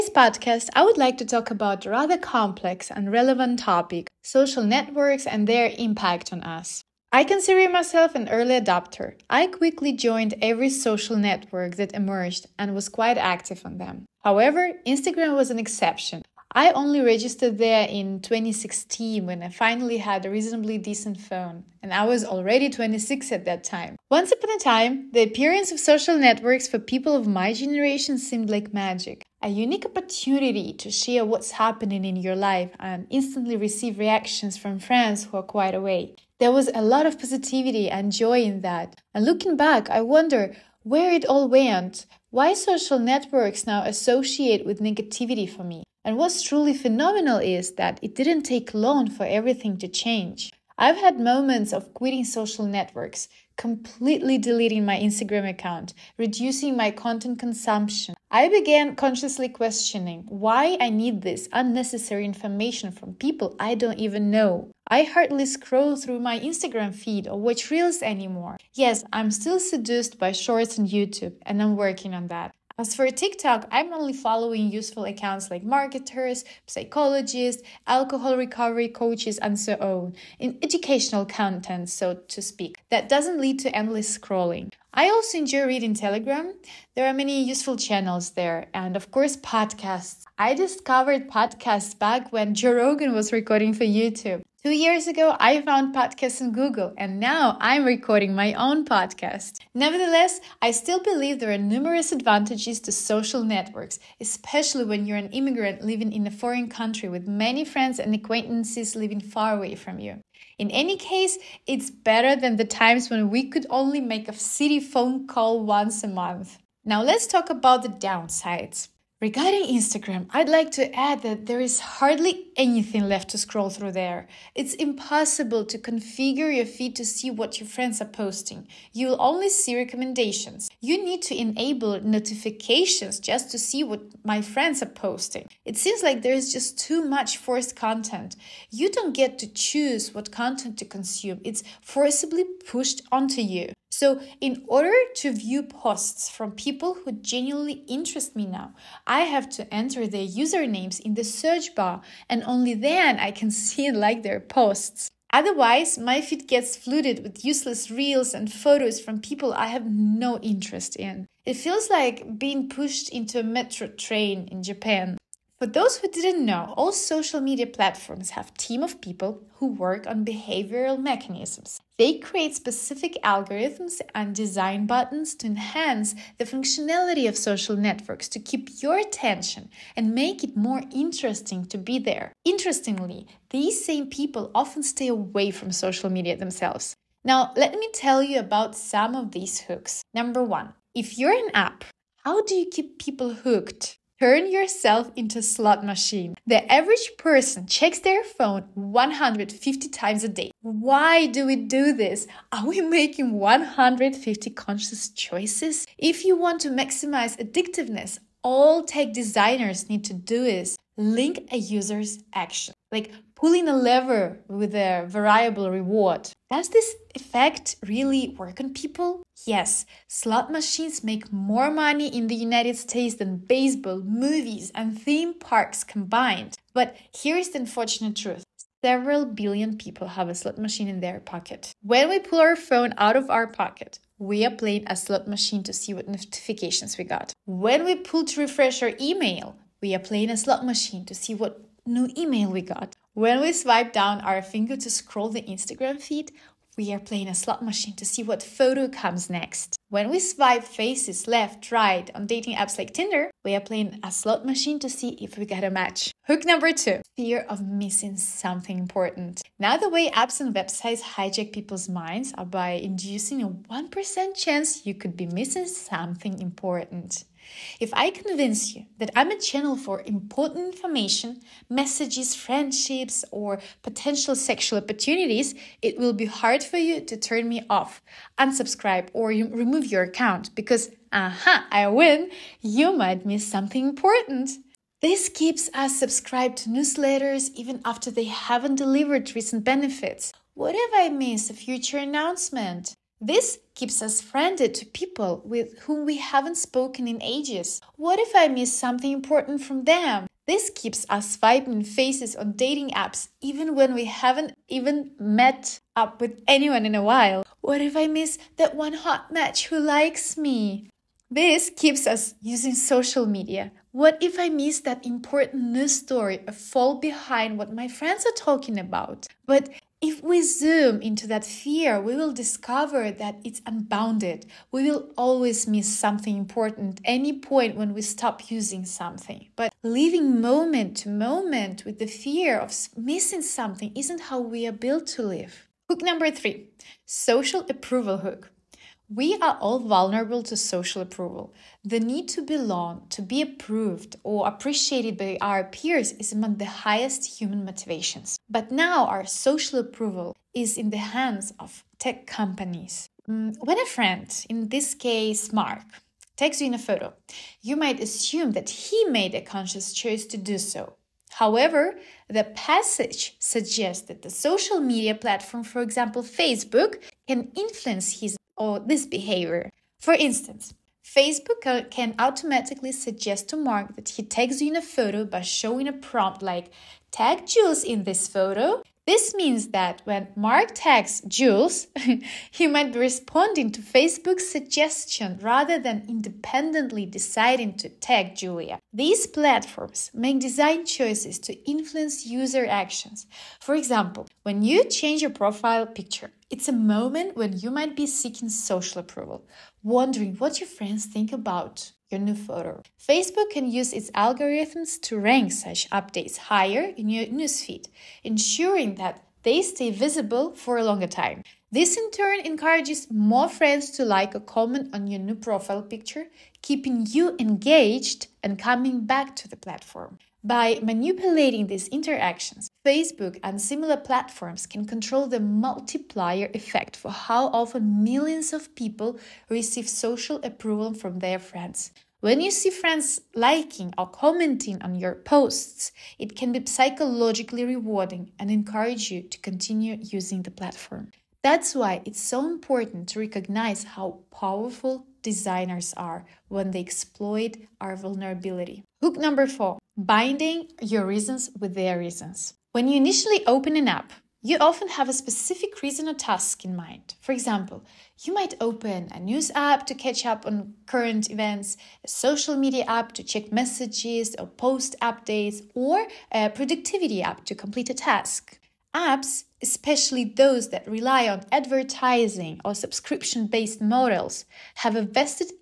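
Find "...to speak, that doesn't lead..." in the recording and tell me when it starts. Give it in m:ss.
1:22.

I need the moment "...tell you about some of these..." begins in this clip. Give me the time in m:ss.
3:07.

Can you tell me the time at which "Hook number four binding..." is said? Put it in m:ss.
7:29.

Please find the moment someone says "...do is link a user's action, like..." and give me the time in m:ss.
3:30.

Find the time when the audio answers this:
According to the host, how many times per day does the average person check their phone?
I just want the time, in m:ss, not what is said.
3:18.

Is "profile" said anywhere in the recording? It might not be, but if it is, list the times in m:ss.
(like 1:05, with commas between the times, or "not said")
6:35, 6:55.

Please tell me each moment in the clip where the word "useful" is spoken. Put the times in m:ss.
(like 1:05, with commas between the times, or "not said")
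1:14, 1:27.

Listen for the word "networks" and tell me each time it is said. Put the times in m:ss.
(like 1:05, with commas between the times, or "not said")
0:04, 0:11, 0:26, 0:42, 0:52, 1:43, 2:57.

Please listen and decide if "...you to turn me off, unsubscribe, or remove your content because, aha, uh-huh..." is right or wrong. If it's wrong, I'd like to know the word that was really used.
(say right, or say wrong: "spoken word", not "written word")
wrong: "account", not "content".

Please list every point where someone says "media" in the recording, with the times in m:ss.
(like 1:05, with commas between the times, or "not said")
2:47, 3:06, 5:13, 6:04, 7:42.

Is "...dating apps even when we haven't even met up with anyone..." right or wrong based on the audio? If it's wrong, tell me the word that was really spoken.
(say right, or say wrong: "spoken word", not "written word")
right.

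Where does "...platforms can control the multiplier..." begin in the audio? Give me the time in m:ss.
7:03.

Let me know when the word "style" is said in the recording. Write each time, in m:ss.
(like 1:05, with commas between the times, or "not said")
not said.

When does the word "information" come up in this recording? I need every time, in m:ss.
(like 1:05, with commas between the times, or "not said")
1:02, 4:30.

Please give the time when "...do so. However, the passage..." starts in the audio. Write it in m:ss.
6:00.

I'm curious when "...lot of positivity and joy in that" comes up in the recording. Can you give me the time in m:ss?
0:36.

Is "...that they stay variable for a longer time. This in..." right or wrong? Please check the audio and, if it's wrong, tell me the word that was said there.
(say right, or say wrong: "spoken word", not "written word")
wrong: "visible", not "variable".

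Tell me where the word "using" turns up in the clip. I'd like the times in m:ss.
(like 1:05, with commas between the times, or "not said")
5:12, 5:28, 7:20.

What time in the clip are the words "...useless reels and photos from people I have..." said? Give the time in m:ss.
2:37.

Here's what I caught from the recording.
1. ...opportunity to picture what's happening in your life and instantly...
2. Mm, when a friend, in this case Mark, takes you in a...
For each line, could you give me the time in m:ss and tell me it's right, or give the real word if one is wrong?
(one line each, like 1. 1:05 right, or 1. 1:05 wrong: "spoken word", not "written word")
1. 0:29 wrong: "share", not "picture"
2. 5:53 right.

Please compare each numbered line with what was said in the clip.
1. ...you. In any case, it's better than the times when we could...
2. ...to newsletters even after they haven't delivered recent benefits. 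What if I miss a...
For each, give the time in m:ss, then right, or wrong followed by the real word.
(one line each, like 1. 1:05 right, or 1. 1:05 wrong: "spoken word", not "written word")
1. 1:49 right
2. 4:46 right.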